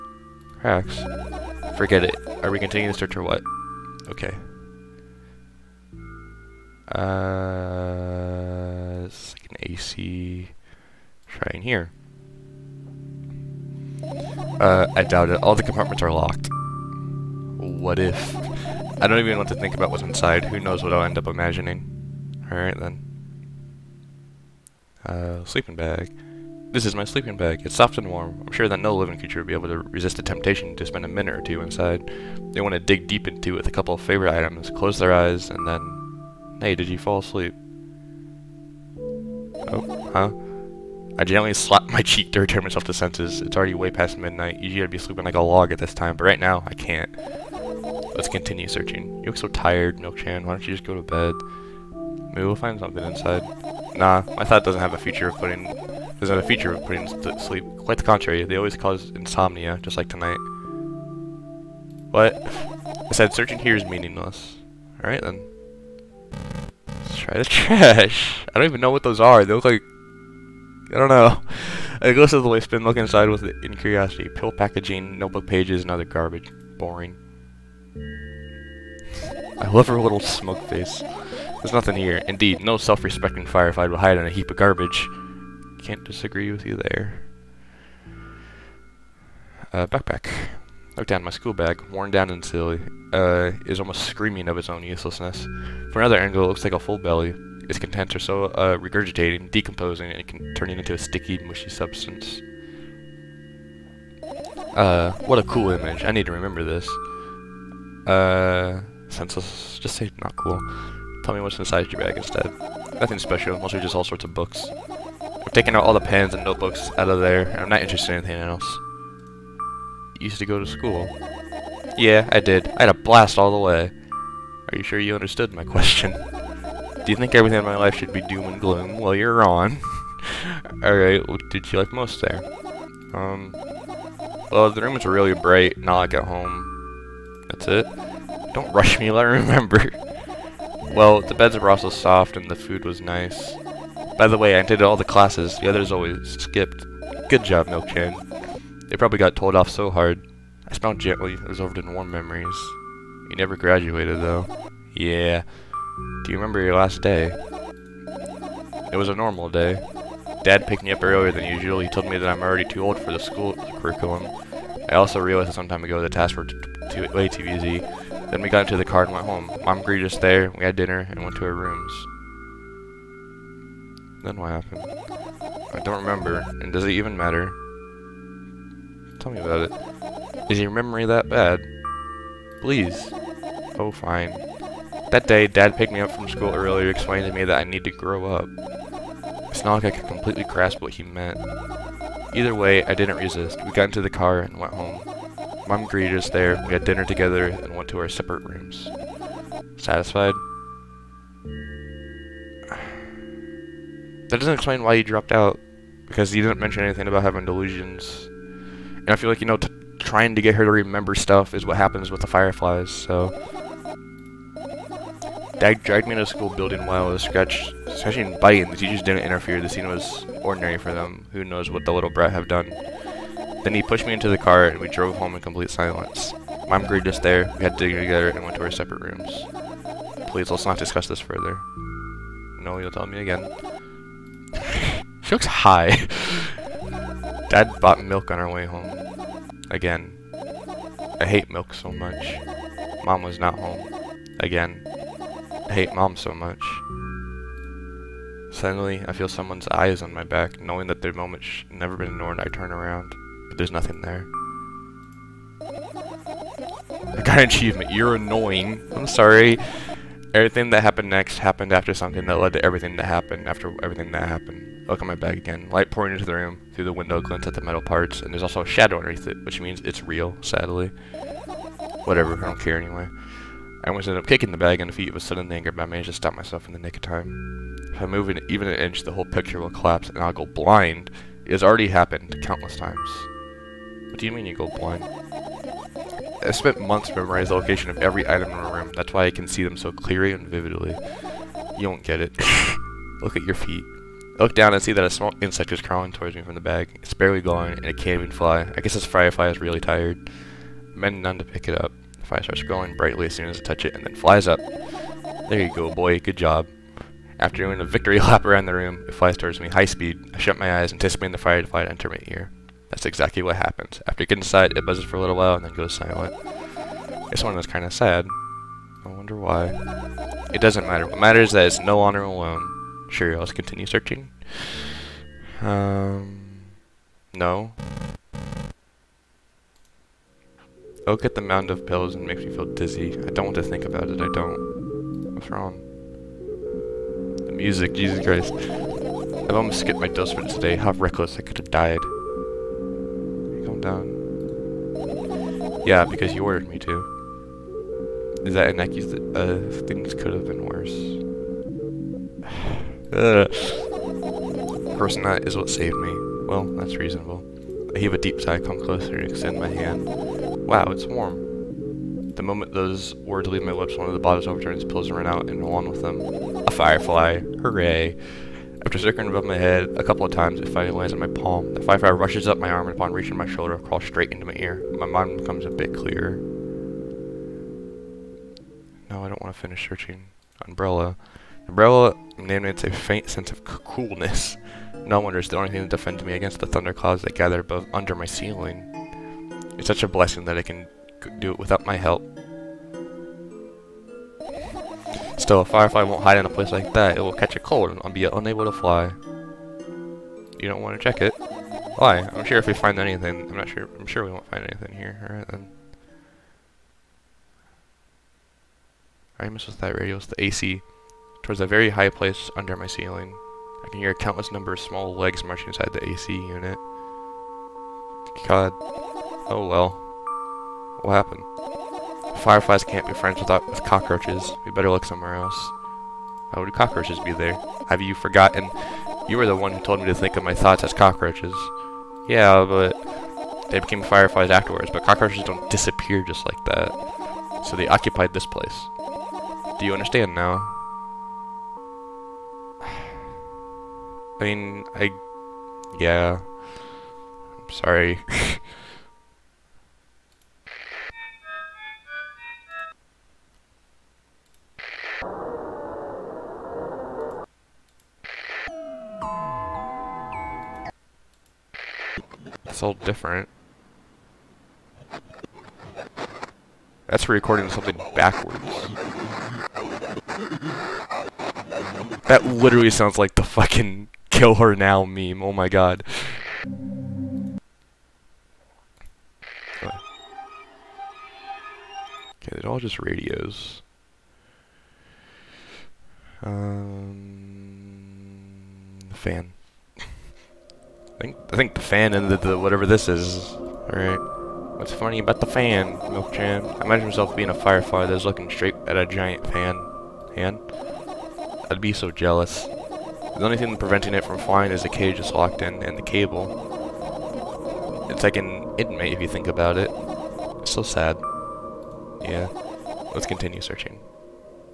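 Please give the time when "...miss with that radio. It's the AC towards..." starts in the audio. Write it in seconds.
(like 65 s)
409 s.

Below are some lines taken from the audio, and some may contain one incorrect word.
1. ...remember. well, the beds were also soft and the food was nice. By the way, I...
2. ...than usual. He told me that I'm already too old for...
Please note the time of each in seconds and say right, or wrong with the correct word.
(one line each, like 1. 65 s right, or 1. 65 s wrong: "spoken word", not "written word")
1. 139 s right
2. 161 s right.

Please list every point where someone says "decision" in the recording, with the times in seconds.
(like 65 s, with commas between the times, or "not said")
not said.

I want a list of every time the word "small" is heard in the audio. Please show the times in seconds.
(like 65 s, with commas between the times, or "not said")
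295 s, 414 s.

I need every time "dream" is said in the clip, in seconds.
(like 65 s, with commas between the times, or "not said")
not said.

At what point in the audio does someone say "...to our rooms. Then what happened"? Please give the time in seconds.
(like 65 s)
171 s.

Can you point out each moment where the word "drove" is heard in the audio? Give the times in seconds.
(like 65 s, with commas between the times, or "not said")
224 s.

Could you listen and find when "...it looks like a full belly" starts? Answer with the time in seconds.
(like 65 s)
96 s.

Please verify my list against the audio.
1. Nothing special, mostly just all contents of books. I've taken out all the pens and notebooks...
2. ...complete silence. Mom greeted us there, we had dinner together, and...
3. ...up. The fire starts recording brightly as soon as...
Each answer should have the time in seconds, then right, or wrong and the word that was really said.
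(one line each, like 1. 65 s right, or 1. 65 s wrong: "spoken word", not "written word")
1. 112 s wrong: "sorts", not "contents"
2. 225 s right
3. 301 s wrong: "glowing", not "recording".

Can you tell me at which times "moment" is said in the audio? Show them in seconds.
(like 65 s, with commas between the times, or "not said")
251 s, 362 s.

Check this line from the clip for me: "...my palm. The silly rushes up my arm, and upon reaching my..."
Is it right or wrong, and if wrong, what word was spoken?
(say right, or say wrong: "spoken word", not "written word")
wrong: "firefly", not "silly".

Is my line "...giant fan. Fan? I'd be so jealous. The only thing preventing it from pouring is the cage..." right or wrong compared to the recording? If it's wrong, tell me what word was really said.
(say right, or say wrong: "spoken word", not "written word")
wrong: "flying", not "pouring".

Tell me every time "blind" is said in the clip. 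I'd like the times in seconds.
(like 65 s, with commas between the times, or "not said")
280 s, 284 s.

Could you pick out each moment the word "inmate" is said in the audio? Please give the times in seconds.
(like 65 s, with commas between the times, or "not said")
508 s.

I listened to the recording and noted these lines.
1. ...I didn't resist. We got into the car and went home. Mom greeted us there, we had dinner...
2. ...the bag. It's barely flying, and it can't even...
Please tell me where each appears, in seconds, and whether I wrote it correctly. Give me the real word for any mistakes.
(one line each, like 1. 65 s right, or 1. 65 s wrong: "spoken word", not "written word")
1. 192 s right
2. 296 s wrong: "glowing", not "flying".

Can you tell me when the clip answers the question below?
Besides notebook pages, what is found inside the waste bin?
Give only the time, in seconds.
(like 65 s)
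74 s.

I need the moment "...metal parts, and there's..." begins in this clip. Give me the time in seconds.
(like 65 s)
267 s.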